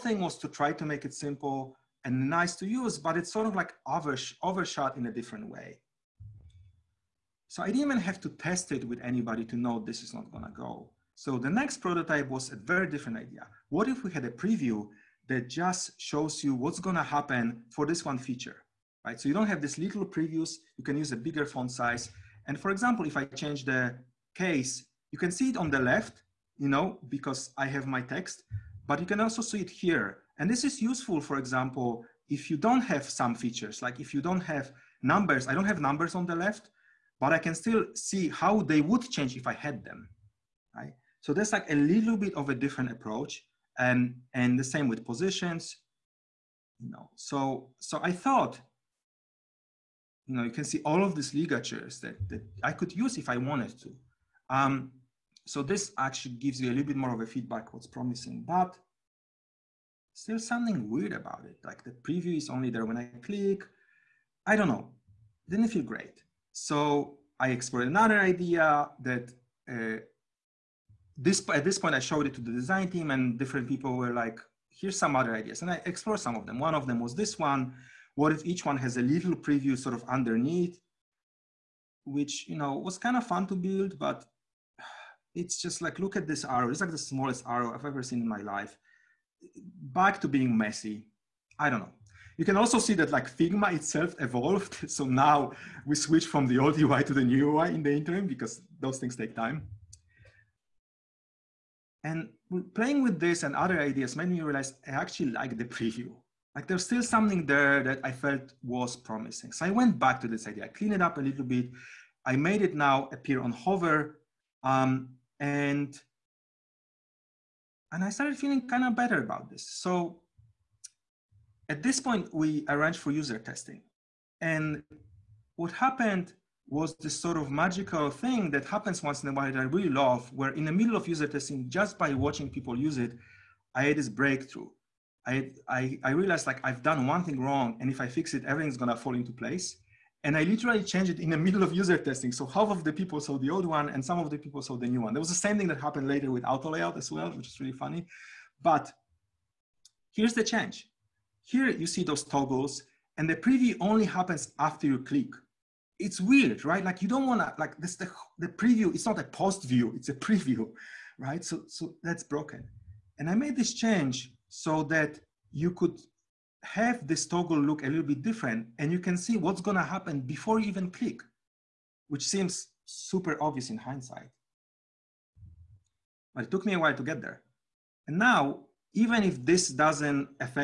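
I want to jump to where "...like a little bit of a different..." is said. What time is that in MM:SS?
00:41.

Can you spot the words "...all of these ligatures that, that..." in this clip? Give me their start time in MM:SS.
00:50.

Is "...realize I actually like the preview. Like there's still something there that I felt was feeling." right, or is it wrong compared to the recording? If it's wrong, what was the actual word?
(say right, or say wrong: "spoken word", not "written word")
wrong: "promising", not "feeling".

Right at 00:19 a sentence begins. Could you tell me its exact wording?
So you don't have these little previews, you can use a bigger font size.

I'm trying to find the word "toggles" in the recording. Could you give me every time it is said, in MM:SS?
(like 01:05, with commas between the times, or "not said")
02:32, 02:47.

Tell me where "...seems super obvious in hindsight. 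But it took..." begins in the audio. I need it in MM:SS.
02:52.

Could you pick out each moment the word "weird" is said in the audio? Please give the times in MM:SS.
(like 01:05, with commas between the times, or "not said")
01:00, 02:36.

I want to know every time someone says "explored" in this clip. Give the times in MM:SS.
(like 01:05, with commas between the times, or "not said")
01:07, 01:15.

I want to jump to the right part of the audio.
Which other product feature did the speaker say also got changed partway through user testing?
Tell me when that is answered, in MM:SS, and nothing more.
02:26.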